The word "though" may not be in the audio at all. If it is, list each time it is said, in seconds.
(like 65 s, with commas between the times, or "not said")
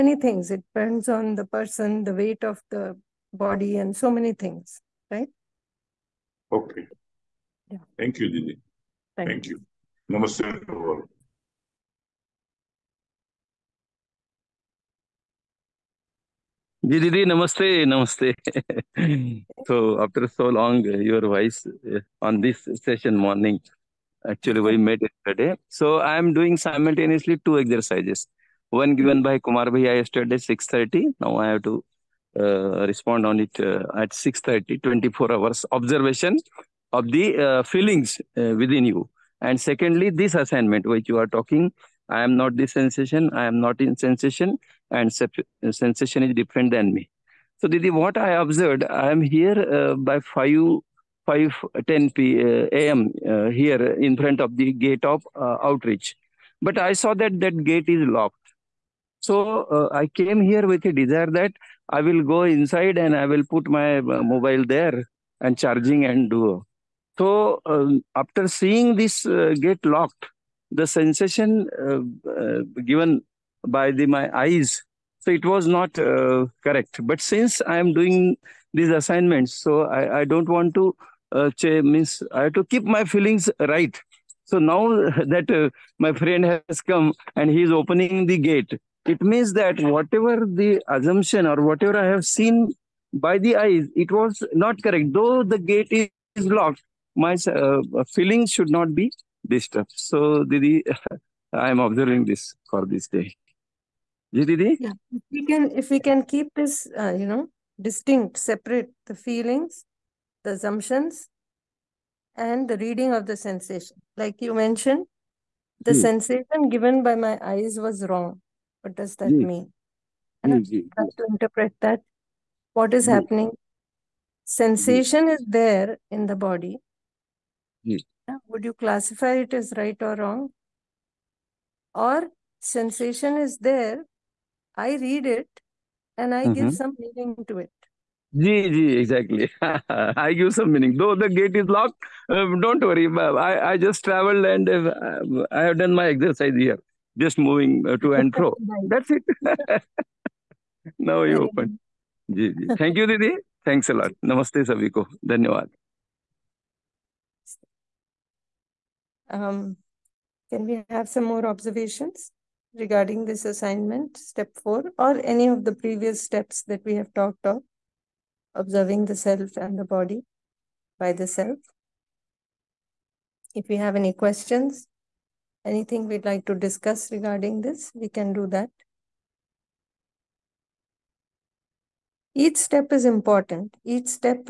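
95 s, 140 s.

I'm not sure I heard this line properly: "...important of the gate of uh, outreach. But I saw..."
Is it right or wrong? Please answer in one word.
wrong.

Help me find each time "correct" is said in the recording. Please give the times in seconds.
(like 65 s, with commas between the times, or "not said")
76 s, 94 s.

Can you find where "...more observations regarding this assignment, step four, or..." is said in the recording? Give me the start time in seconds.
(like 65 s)
161 s.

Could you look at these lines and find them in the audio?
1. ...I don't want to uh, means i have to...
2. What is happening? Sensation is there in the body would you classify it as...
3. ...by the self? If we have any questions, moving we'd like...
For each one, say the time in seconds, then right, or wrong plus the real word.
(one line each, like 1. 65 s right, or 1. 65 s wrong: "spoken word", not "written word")
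1. 80 s right
2. 122 s right
3. 170 s wrong: "anything", not "moving".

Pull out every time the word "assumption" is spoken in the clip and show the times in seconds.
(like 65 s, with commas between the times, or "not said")
90 s, 110 s.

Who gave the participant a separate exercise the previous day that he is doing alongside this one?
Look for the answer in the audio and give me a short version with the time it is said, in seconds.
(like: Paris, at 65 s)
Kumar Bhaiya, at 29 s.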